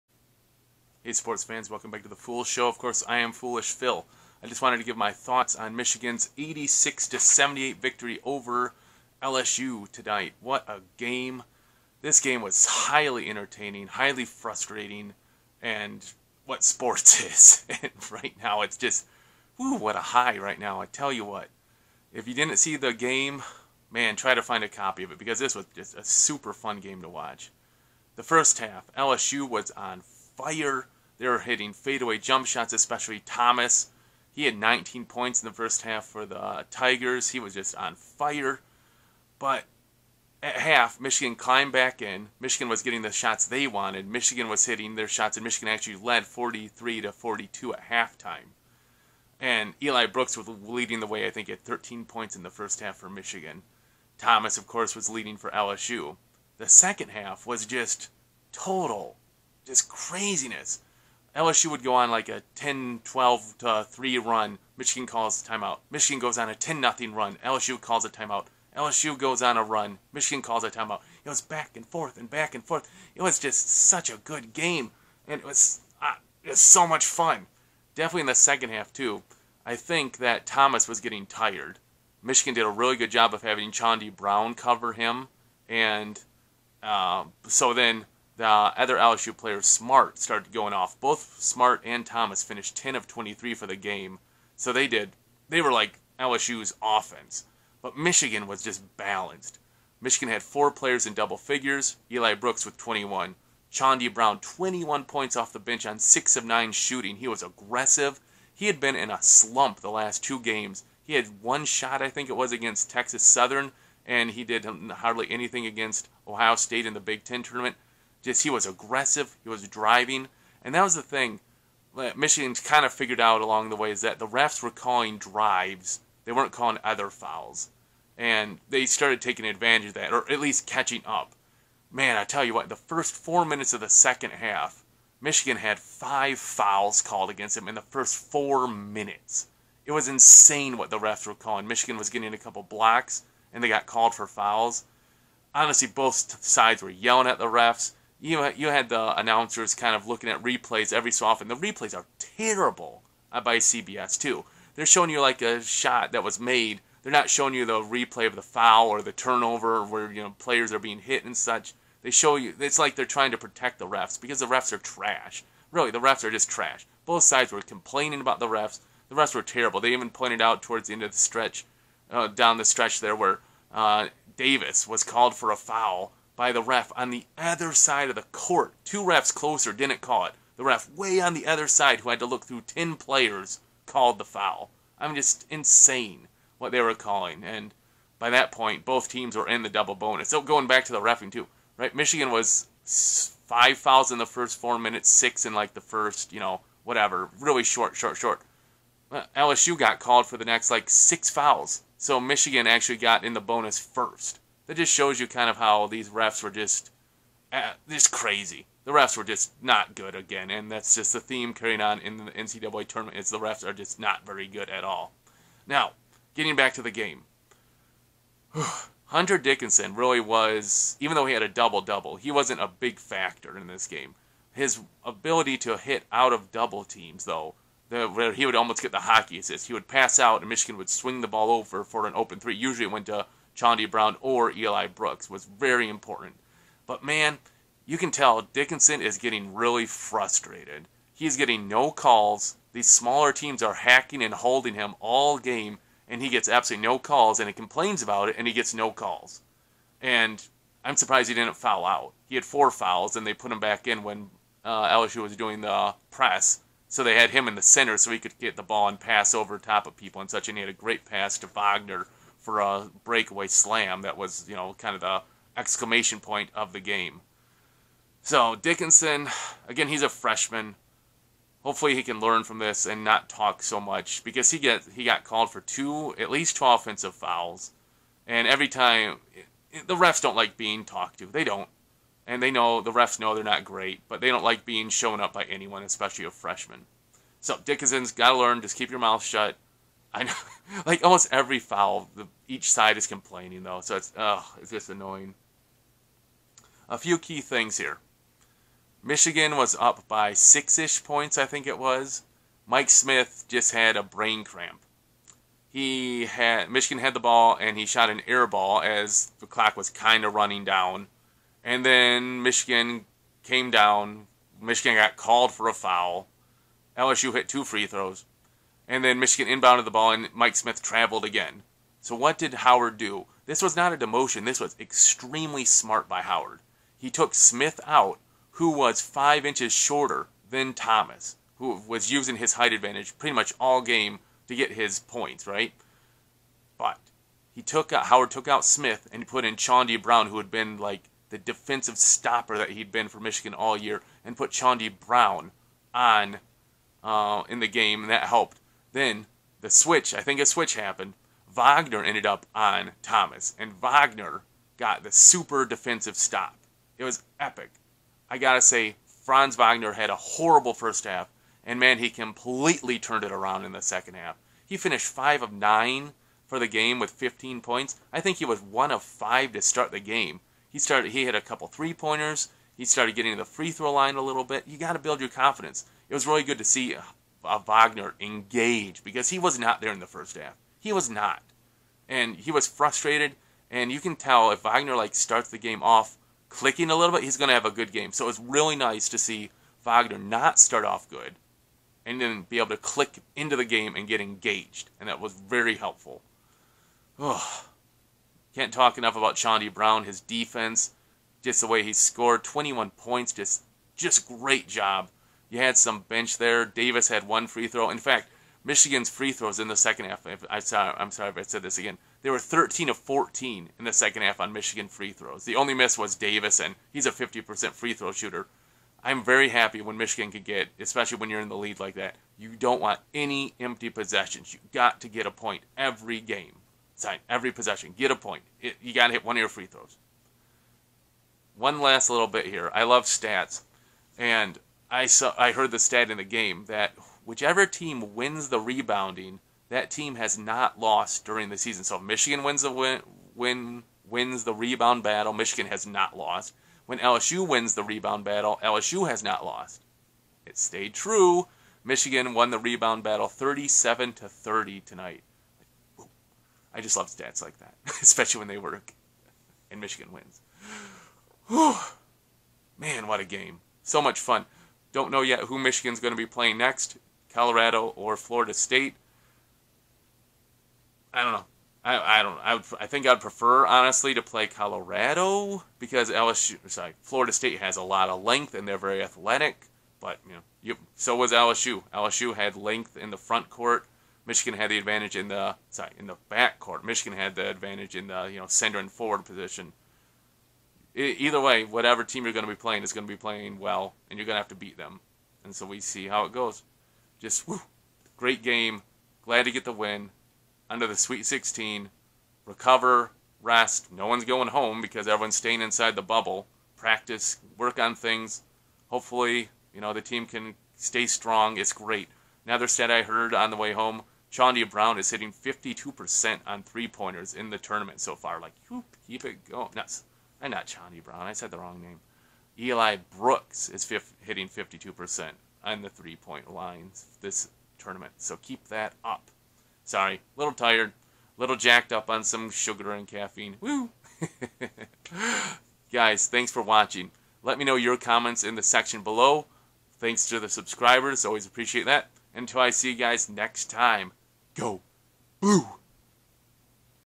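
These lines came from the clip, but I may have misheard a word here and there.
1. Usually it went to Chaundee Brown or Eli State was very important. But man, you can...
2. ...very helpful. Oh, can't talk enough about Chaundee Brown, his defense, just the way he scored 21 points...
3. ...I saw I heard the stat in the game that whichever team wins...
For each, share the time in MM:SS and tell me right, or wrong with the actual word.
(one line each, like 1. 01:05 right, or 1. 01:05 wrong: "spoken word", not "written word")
1. 03:52 wrong: "Brooks", not "State"
2. 06:35 right
3. 07:14 right.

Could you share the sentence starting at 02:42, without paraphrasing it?
They show you it's like they're trying to protect the refs because the refs are trash.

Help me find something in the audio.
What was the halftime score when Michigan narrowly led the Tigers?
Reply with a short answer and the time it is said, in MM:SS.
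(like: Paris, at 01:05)
43 to 42, at 00:46.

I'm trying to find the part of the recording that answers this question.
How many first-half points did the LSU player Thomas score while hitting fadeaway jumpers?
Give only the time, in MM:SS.
00:34.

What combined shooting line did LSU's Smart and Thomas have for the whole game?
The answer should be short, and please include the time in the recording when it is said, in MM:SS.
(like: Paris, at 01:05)
10 of 23, at 01:32.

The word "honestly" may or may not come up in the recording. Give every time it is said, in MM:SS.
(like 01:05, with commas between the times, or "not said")
02:25, 07:53.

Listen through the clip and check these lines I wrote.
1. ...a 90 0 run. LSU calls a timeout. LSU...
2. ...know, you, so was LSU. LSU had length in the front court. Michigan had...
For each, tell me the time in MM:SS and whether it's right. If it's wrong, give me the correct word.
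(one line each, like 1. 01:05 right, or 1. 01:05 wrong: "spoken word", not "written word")
1. 01:06 wrong: "10", not "90"
2. 08:00 right.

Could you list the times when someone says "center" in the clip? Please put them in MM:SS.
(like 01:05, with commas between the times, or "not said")
04:17, 08:08.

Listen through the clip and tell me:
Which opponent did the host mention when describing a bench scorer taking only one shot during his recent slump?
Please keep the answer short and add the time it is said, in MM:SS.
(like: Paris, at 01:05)
Texas Southern, at 01:52.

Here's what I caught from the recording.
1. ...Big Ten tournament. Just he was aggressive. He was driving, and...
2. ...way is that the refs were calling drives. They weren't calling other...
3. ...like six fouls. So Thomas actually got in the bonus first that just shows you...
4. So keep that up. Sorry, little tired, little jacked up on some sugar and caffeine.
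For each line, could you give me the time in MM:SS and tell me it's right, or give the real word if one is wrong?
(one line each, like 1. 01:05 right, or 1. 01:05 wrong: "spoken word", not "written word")
1. 01:56 right
2. 02:03 right
3. 03:20 wrong: "Michigan", not "Thomas"
4. 08:48 right.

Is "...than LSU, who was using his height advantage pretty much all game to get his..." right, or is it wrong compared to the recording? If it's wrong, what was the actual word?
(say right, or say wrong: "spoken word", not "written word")
wrong: "Thomas", not "LSU".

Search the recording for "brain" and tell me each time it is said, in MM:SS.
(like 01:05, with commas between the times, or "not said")
05:04.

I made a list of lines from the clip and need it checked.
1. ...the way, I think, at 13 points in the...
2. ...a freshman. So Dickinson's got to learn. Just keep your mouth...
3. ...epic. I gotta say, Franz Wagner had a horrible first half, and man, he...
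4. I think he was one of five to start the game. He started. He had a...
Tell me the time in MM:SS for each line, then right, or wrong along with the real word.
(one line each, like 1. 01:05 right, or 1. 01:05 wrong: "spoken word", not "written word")
1. 00:51 right
2. 04:46 right
3. 05:57 right
4. 06:08 right.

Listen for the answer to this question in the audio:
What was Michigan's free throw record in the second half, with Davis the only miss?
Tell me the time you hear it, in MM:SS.
06:52.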